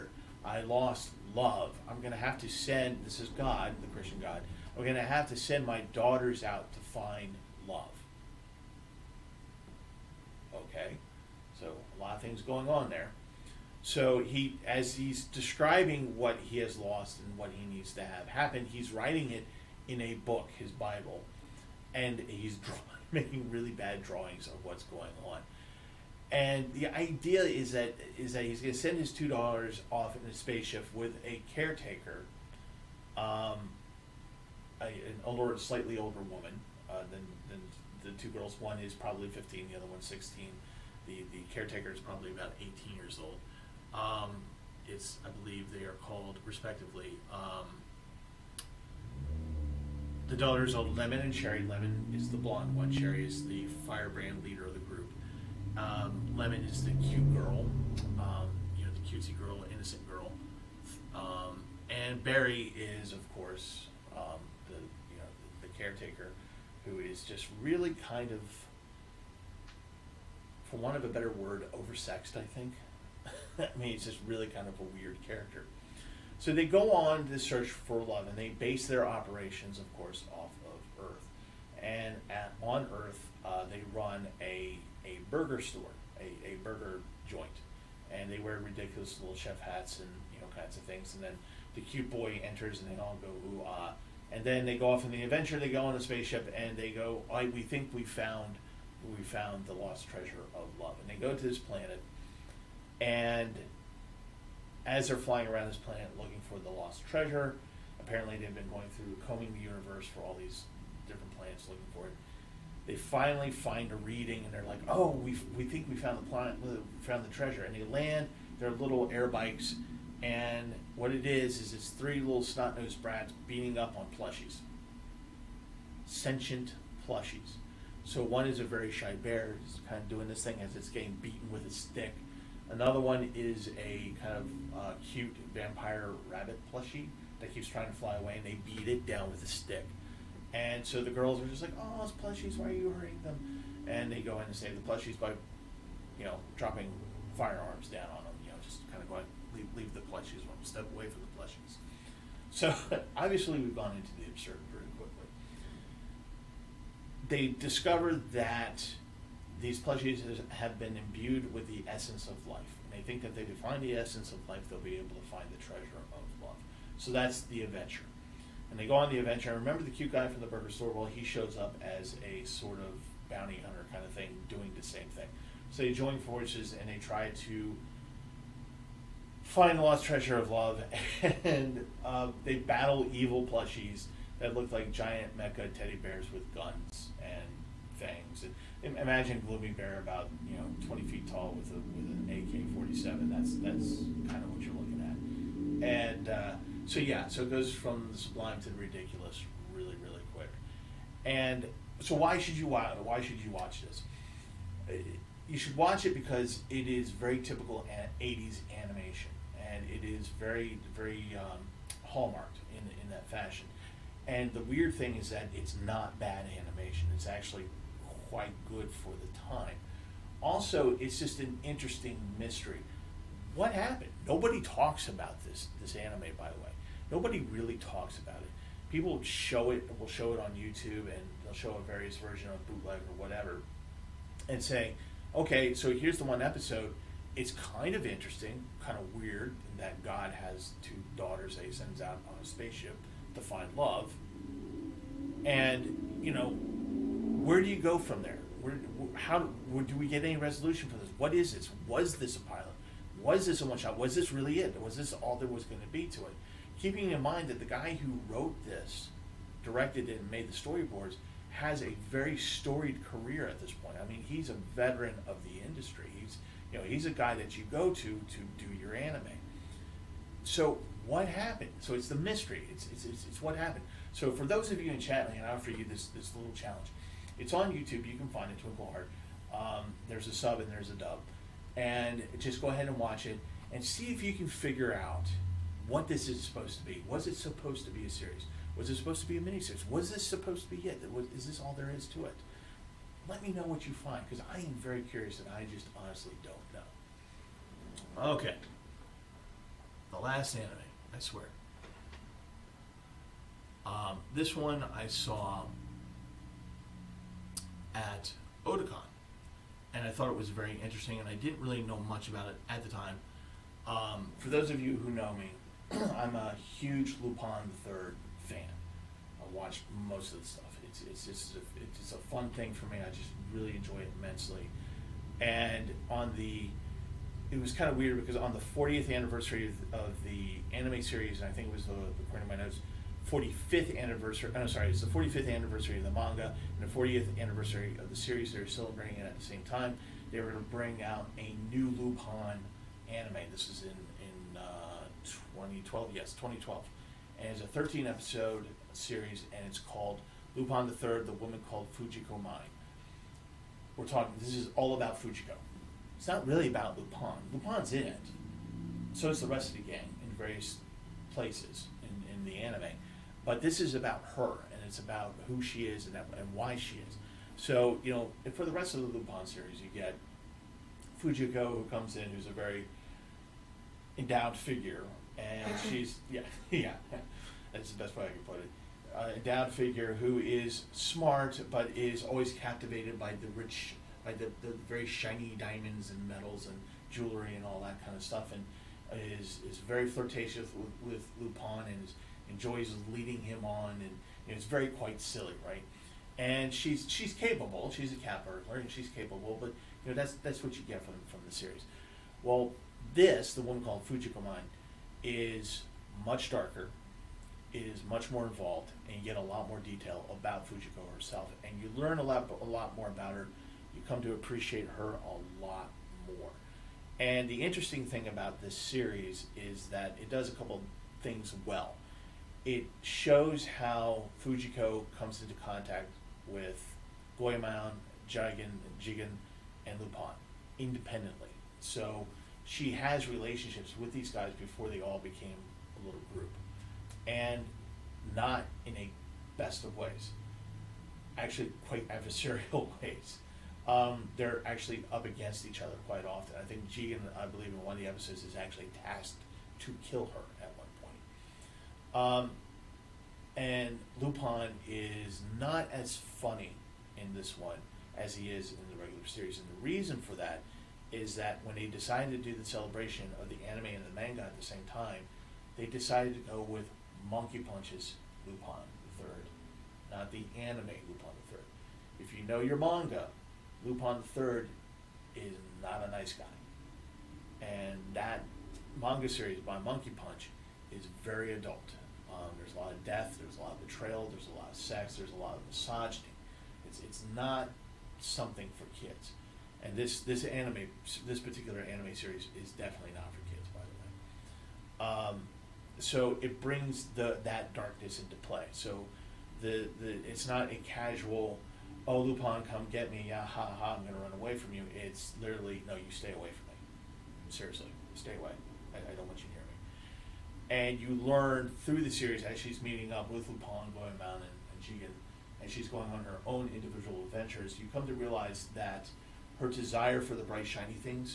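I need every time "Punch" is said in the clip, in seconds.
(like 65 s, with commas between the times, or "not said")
467 s, 480 s.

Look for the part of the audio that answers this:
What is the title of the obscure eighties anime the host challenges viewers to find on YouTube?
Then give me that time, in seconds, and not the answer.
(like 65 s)
278 s.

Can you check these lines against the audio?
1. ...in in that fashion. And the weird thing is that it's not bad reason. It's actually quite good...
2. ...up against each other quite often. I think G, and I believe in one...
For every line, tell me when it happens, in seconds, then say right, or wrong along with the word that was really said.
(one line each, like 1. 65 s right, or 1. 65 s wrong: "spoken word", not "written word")
1. 212 s wrong: "animation", not "reason"
2. 445 s right.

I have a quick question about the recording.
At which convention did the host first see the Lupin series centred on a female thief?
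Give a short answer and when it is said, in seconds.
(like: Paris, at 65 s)
Oticon, at 308 s.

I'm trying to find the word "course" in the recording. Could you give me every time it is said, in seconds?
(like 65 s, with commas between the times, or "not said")
63 s, 79 s.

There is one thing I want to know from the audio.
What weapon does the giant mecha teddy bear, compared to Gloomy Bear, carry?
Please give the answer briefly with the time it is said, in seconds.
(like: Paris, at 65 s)
AK-47, at 192 s.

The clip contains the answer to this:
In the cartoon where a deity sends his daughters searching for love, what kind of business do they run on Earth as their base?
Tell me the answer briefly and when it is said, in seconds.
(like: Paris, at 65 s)
Burger joint, at 86 s.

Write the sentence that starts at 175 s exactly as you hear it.
So they join forces and they try to find the lost treasure of love.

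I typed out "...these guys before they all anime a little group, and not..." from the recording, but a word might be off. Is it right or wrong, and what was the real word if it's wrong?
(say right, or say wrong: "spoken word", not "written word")
wrong: "became", not "anime".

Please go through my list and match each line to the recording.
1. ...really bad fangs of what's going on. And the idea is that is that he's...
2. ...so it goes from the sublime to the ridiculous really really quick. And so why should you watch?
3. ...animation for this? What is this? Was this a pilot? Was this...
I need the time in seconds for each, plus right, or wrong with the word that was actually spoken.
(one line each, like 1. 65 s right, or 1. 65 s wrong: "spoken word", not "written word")
1. 23 s wrong: "drawings", not "fangs"
2. 197 s right
3. 250 s wrong: "resolution", not "animation".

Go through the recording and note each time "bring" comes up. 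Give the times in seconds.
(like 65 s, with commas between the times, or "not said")
340 s, 496 s.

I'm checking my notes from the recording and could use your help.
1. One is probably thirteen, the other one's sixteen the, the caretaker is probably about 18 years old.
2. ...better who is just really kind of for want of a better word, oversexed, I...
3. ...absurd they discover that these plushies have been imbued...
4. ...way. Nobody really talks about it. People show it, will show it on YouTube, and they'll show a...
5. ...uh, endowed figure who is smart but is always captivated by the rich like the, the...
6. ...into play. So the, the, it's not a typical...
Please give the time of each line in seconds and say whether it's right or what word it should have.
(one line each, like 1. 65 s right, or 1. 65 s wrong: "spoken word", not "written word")
1. 38 s wrong: "fifteen", not "thirteen"
2. 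65 s wrong: "caretaker", not "better"
3. 154 s right
4. 226 s right
5. 379 s right
6. 498 s wrong: "casual", not "typical".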